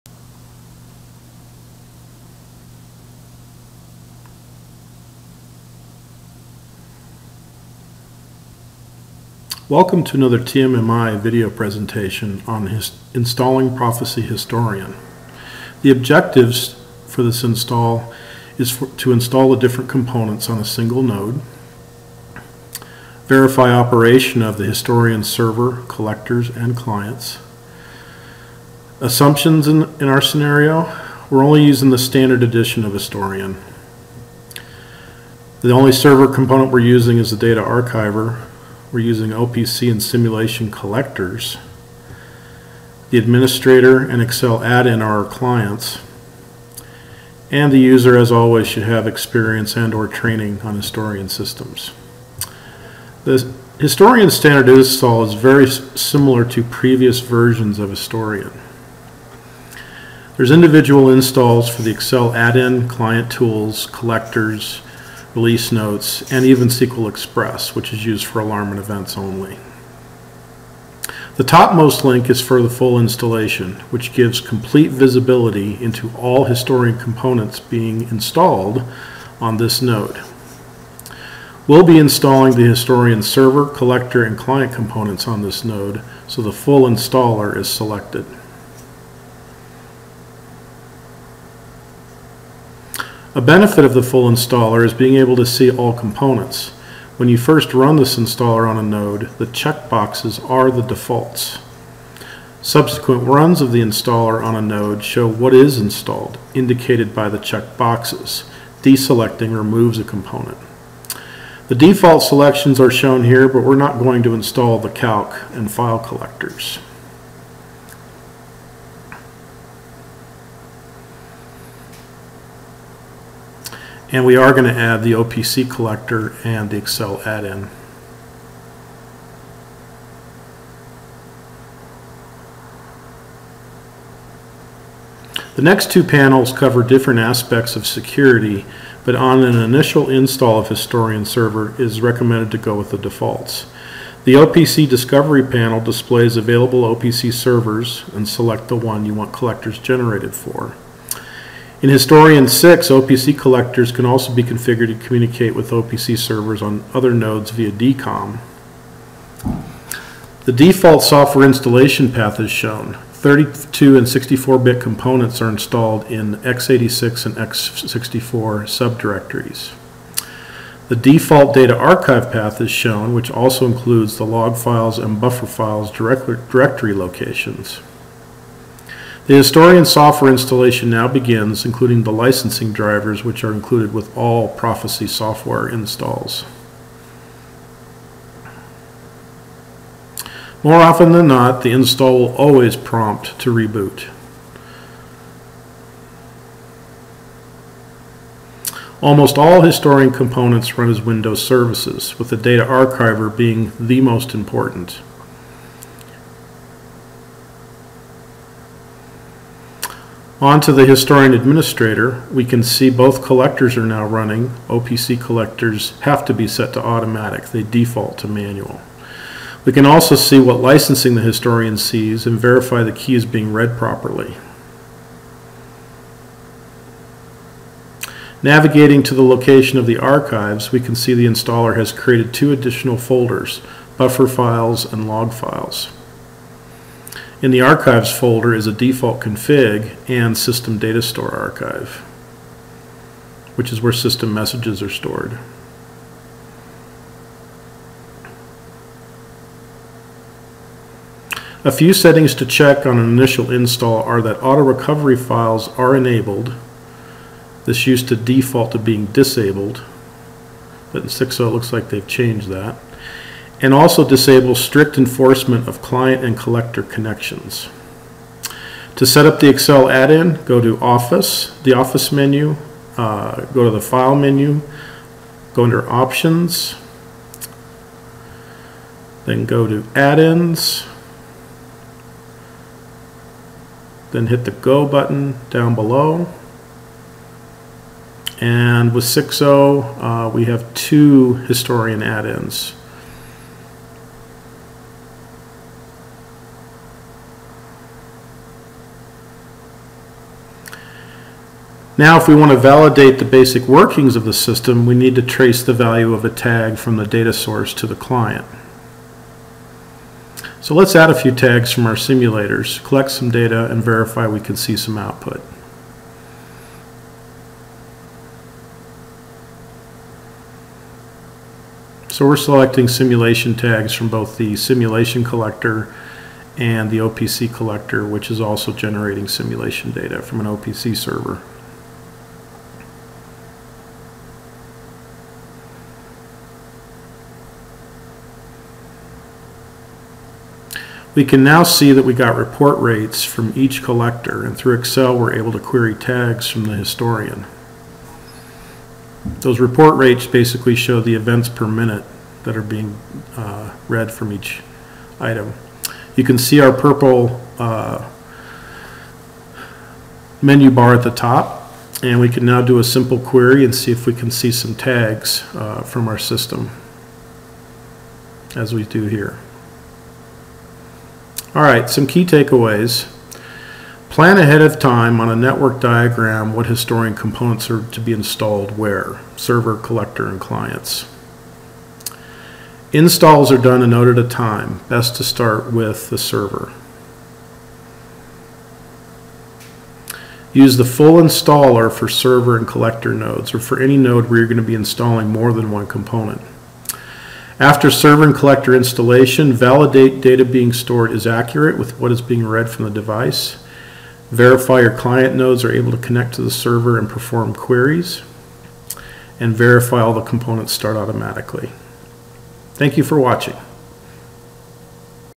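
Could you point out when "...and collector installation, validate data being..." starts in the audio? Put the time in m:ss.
6:38.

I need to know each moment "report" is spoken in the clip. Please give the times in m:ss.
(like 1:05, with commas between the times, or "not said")
5:42, 5:49.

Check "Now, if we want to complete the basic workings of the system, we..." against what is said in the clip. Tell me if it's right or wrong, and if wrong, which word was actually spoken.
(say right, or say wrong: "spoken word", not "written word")
wrong: "validate", not "complete".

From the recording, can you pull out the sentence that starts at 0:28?
Assumptions in, in our scenario, we're only using the standard edition of Historian.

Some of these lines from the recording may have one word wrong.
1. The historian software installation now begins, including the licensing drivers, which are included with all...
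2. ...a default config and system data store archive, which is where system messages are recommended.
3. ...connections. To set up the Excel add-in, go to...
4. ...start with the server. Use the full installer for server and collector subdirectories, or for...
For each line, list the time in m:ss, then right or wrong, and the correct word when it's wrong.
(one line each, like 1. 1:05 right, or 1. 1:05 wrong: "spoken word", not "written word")
1. 2:59 right
2. 3:58 wrong: "stored", not "recommended"
3. 4:26 right
4. 6:25 wrong: "nodes", not "subdirectories".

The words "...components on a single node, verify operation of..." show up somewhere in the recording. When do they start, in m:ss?
0:19.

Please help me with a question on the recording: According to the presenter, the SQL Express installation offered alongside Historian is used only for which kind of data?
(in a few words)
Alarm and events.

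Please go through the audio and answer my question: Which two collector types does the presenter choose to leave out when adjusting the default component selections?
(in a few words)
Calc and file.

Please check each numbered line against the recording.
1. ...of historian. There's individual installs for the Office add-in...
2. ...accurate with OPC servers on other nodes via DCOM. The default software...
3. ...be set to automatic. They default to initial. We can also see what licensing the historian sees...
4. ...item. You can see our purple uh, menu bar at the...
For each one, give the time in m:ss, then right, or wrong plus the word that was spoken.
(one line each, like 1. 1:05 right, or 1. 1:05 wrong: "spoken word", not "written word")
1. 0:57 wrong: "Excel", not "Office"
2. 2:35 wrong: "communicate", not "accurate"
3. 3:36 wrong: "manual", not "initial"
4. 5:55 right.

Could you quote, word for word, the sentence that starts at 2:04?
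And we are going to add the OPC collector and the Excel add-in.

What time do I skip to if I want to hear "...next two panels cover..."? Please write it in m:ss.
2:15.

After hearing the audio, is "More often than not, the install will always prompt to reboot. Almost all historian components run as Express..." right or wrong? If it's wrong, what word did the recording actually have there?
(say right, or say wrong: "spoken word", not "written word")
wrong: "Windows", not "Express".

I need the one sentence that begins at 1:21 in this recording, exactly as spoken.
We'll be installing the historian server, collector, and client components on this node, so the full installer is selected.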